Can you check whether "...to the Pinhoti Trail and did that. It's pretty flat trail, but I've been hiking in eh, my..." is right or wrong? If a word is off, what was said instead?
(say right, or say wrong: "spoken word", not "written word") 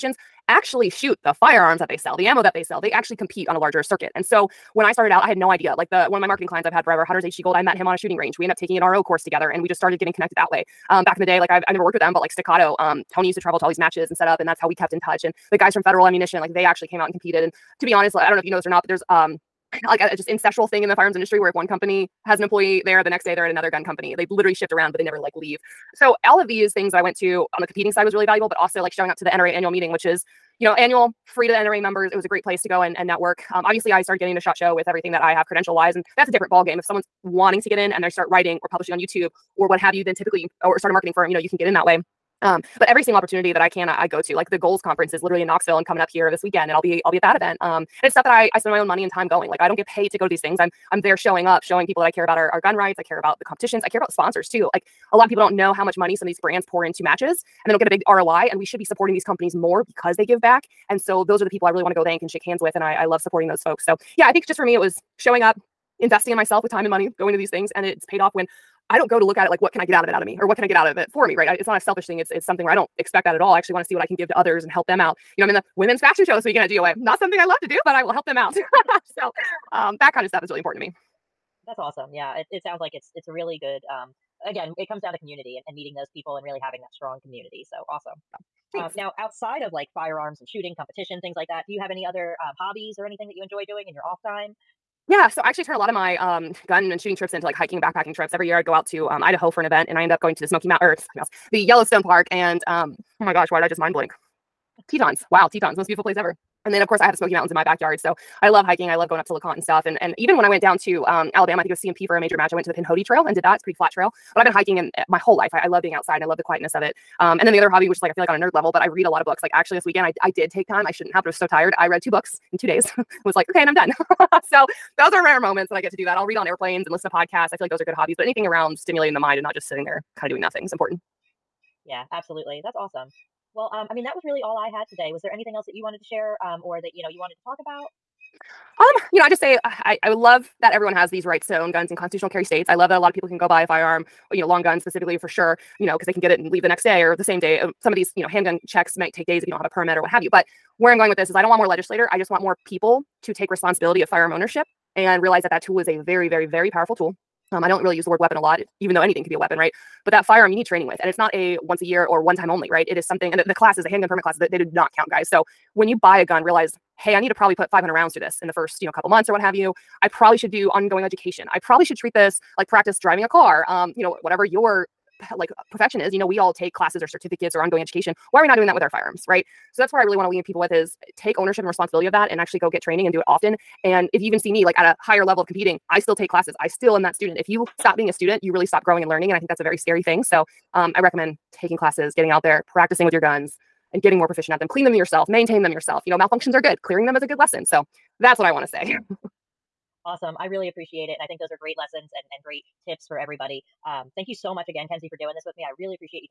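right.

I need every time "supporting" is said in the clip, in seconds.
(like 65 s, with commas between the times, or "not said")
58 s, 63 s.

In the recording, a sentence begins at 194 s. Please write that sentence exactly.
Clean them yourself, maintain them yourself.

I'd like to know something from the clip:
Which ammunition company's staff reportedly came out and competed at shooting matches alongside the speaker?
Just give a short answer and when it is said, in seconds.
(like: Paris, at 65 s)
Federal Ammunition, at 15 s.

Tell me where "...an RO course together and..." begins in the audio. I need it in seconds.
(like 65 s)
8 s.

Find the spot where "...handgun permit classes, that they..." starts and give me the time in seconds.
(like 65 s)
163 s.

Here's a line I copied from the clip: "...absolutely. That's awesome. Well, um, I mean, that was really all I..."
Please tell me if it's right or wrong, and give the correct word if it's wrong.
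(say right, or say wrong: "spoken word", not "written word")
right.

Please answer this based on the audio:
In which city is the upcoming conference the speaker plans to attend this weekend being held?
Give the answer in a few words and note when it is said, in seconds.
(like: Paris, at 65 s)
Knoxville, at 45 s.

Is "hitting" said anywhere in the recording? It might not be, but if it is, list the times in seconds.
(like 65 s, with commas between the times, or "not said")
not said.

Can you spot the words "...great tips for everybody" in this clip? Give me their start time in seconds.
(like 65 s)
202 s.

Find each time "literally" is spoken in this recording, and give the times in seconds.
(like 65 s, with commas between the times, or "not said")
24 s, 45 s.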